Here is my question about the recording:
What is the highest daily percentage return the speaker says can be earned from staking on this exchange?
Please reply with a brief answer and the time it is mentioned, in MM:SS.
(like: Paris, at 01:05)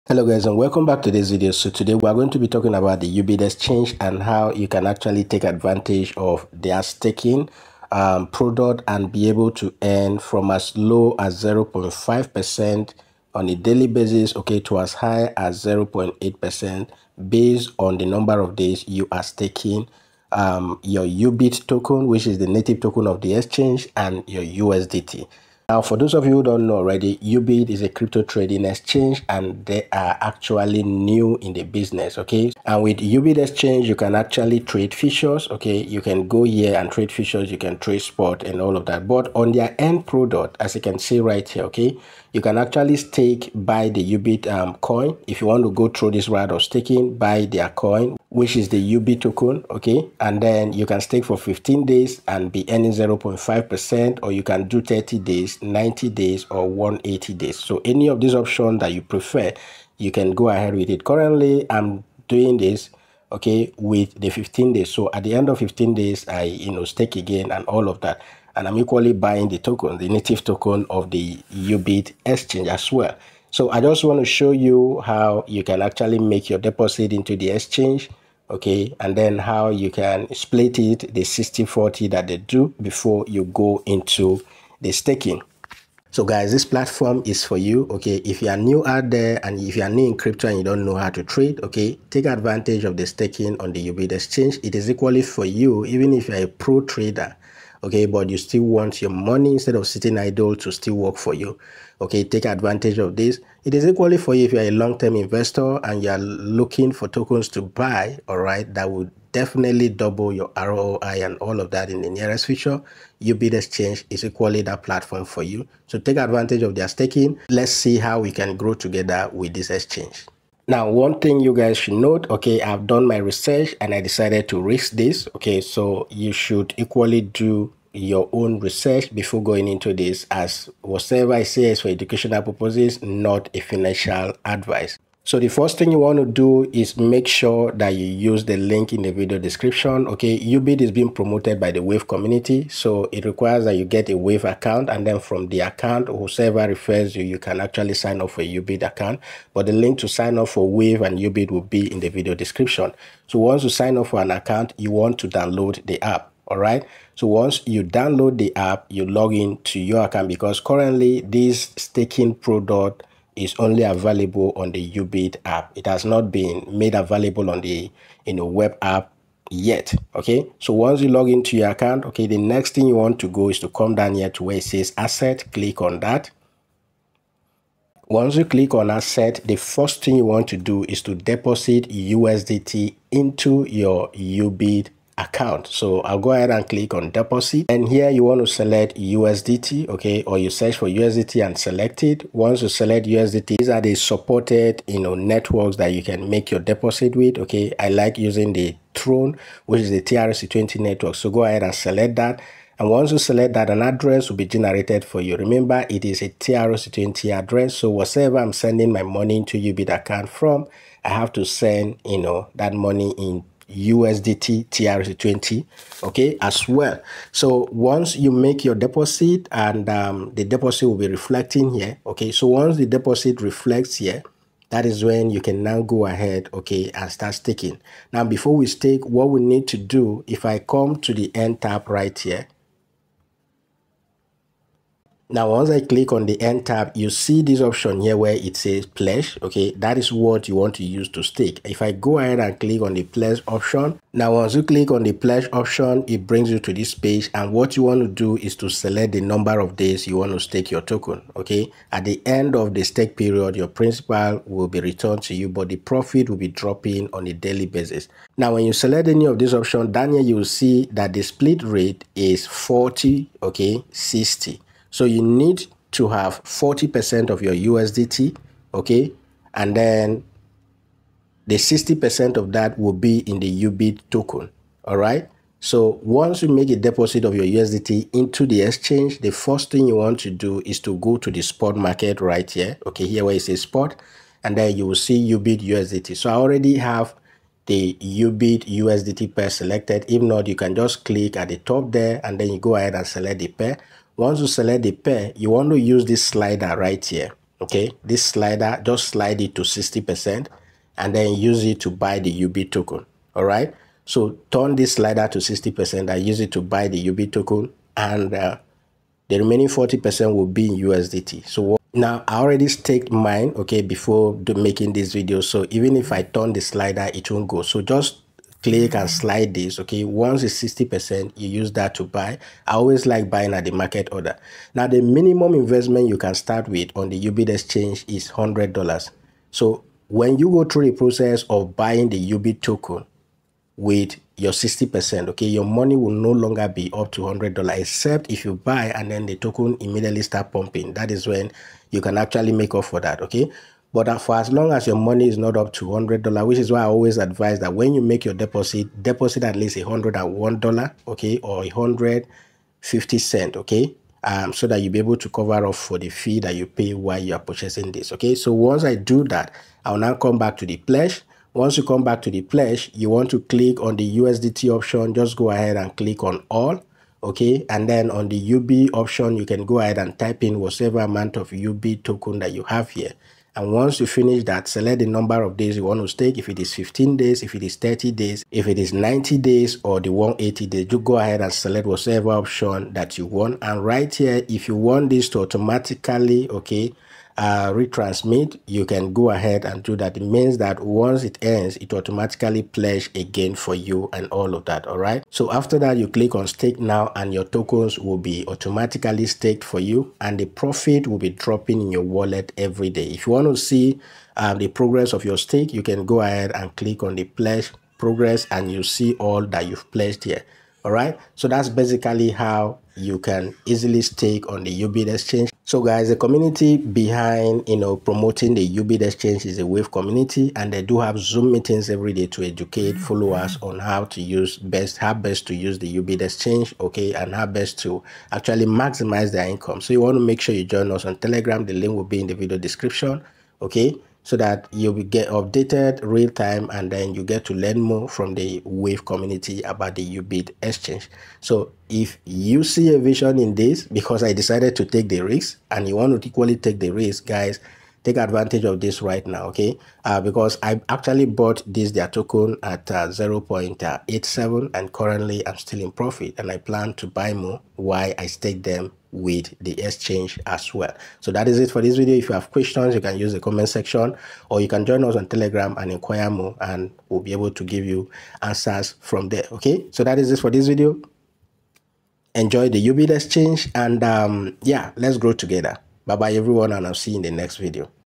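0.8%, at 00:15.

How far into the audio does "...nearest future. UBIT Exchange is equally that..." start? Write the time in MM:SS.
01:52.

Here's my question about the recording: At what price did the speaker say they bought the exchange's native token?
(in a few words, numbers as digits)
0.87.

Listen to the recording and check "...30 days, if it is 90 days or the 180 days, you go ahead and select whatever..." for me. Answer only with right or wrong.
right.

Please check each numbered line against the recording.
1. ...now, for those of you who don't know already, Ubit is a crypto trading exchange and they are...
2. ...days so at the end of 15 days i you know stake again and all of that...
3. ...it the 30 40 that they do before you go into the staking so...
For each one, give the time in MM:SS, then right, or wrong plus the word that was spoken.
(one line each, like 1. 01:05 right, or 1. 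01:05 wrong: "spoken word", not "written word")
1. 00:25 right
2. 01:04 right
3. 01:20 wrong: "60", not "30".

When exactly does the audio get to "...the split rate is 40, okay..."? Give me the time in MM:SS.
04:21.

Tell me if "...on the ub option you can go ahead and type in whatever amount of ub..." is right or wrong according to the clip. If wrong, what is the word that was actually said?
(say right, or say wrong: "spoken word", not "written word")
right.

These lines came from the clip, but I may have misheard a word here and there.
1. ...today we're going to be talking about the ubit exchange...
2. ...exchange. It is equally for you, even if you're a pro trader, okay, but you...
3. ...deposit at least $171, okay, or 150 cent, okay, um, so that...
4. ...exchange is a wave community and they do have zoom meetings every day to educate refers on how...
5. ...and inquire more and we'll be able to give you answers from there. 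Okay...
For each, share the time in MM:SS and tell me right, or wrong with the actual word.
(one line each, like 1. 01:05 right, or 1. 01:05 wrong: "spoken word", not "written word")
1. 00:01 right
2. 01:34 right
3. 05:49 wrong: "101", not "171"
4. 06:59 wrong: "followers", not "refers"
5. 07:45 right.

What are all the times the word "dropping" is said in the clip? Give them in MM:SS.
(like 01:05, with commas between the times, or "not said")
04:16, 06:41.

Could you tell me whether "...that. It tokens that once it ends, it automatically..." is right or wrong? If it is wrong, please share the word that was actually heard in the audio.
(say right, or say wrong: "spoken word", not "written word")
wrong: "means", not "tokens".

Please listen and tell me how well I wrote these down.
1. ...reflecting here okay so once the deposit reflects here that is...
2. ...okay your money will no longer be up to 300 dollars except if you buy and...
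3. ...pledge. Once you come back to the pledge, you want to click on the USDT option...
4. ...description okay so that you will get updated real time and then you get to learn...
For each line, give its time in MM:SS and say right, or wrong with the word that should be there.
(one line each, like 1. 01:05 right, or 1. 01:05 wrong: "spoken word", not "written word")
1. 03:41 right
2. 05:35 wrong: "100", not "300"
3. 06:00 right
4. 07:12 right.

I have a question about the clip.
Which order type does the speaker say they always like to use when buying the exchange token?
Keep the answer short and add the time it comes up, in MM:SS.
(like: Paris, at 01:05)
market order, at 05:23.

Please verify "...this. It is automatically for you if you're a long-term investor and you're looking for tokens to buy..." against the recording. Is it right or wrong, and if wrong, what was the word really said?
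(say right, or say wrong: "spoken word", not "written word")
wrong: "equally", not "automatically".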